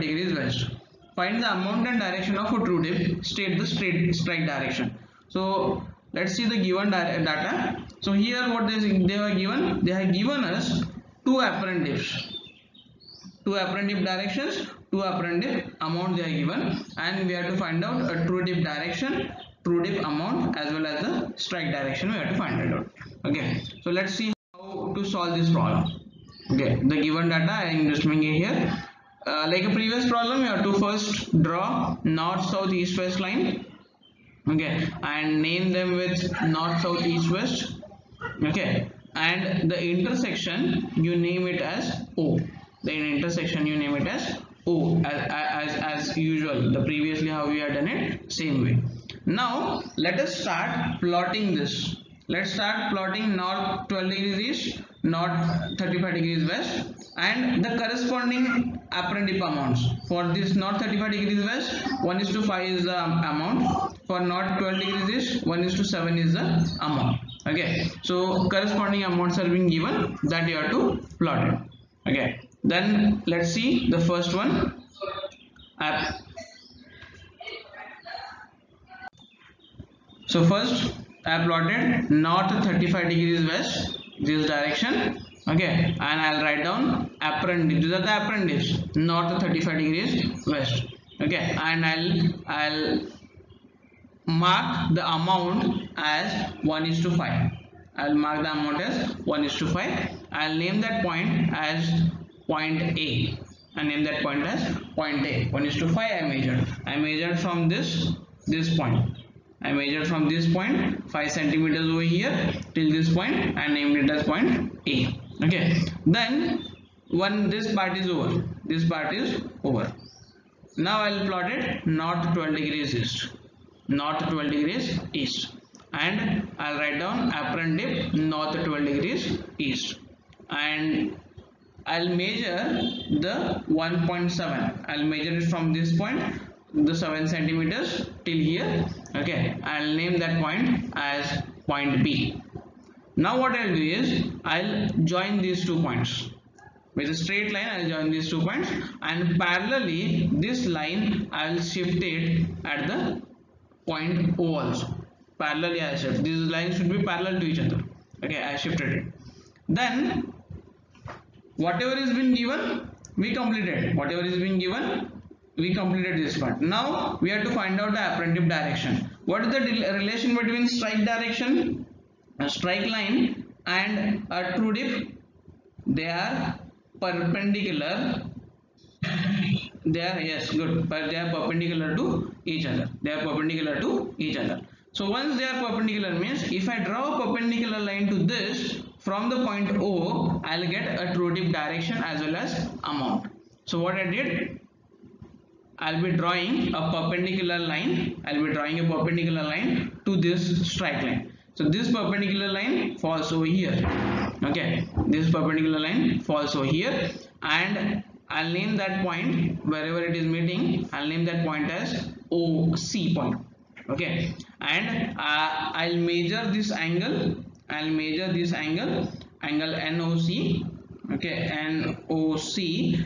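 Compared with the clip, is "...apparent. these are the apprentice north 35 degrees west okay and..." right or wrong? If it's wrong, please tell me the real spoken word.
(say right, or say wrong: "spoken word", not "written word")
right.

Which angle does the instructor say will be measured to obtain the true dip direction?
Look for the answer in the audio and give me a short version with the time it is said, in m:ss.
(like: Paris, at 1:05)
Angle NOC, at 3:39.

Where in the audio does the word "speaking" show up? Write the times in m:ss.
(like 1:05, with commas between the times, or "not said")
not said.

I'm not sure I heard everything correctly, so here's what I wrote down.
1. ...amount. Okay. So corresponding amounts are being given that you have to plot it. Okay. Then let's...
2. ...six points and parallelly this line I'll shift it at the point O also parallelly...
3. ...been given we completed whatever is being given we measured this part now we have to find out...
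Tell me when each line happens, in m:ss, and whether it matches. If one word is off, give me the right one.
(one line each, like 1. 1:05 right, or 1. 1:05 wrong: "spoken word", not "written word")
1. 1:06 right
2. 2:28 wrong: "two", not "six"
3. 2:42 wrong: "completed", not "measured".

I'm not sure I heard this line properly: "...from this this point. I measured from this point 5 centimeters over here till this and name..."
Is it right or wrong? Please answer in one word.
right.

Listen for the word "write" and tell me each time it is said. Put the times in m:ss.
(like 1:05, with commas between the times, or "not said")
1:26, 2:06.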